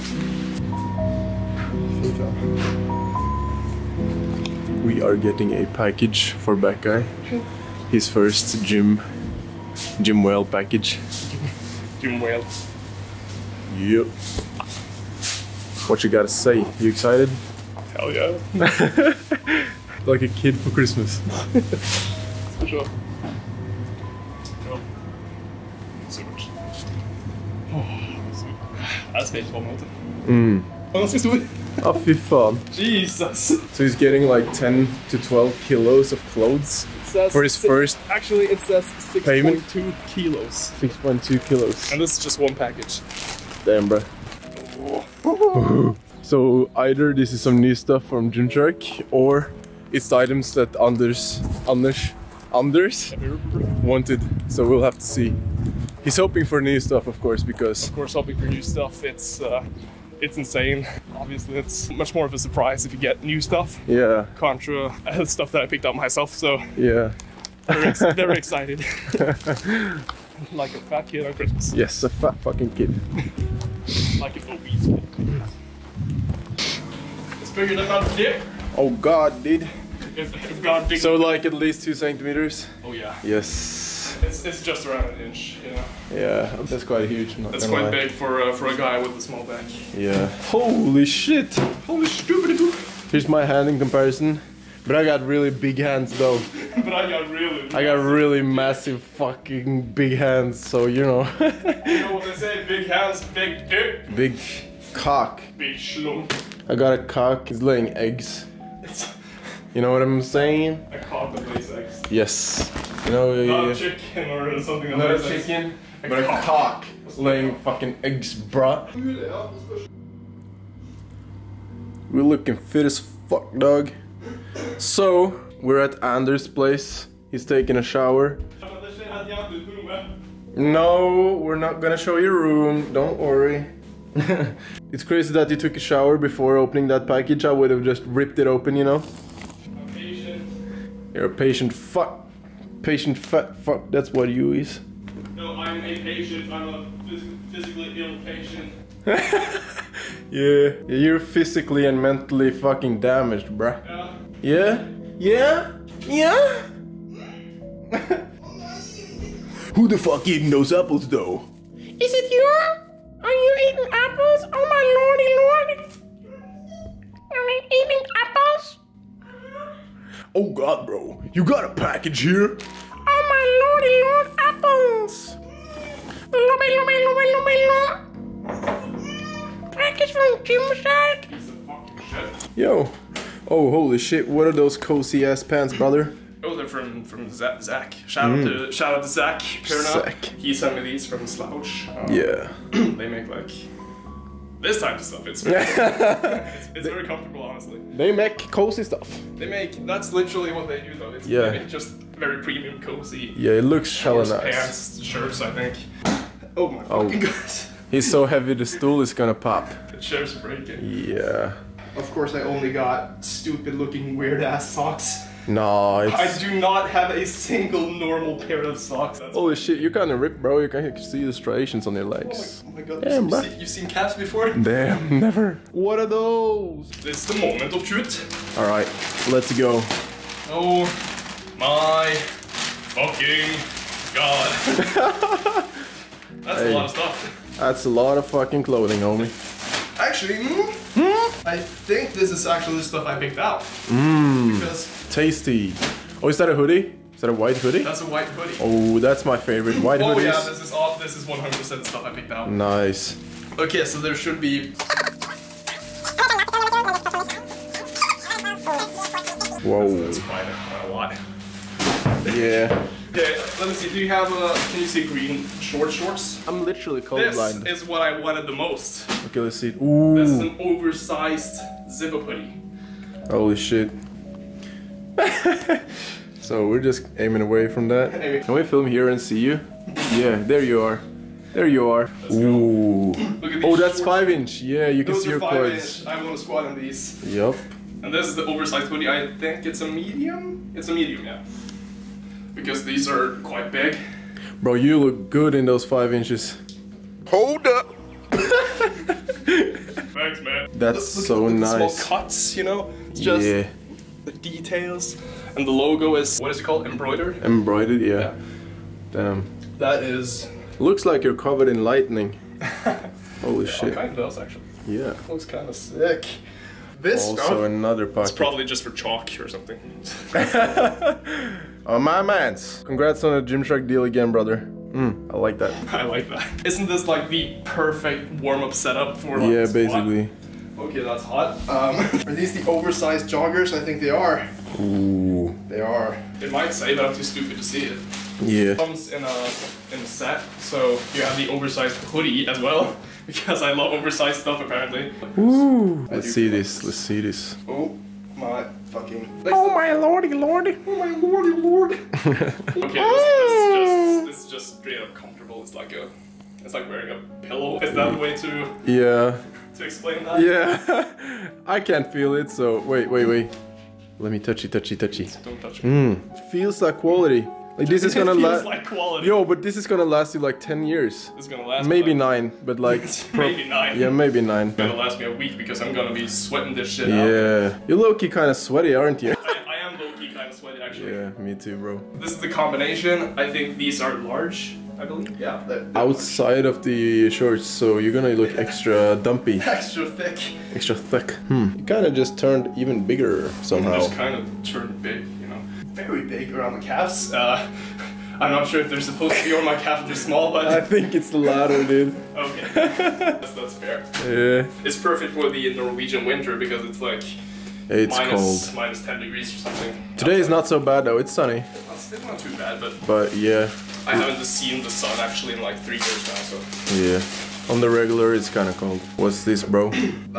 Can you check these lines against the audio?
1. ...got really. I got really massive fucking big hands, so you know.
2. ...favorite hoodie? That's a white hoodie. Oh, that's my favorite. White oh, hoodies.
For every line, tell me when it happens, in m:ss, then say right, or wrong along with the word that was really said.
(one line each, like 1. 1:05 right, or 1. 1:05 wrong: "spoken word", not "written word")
1. 1:37 right
2. 4:07 wrong: "white", not "favorite".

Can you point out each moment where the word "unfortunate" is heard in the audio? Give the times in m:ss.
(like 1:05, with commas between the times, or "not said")
not said.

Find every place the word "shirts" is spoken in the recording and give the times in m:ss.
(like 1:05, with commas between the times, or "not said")
3:25, 3:30.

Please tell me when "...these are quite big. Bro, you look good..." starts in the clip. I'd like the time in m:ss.
4:52.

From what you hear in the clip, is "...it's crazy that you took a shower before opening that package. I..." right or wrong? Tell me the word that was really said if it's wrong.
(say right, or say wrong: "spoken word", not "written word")
right.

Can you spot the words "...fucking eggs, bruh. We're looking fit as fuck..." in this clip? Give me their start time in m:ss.
1:57.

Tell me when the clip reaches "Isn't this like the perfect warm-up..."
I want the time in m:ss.
5:26.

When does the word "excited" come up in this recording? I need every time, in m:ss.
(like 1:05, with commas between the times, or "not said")
0:16, 1:08.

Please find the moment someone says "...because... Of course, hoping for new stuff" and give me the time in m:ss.
0:57.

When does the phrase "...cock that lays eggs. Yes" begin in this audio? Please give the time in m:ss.
1:50.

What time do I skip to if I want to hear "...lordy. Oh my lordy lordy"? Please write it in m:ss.
5:50.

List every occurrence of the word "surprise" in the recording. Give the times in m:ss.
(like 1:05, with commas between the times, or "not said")
1:02.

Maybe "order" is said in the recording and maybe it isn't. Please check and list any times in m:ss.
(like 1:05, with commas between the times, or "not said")
not said.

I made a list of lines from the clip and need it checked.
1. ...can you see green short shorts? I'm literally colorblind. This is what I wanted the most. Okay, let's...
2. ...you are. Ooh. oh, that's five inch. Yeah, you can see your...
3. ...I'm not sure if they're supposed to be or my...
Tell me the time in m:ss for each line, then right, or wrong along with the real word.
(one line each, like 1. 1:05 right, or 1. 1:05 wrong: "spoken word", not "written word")
1. 4:24 right
2. 4:41 right
3. 6:38 right.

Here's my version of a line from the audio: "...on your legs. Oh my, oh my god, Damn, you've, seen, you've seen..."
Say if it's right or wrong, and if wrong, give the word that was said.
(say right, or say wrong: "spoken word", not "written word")
right.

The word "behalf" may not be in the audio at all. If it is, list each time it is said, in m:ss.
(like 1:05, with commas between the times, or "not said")
not said.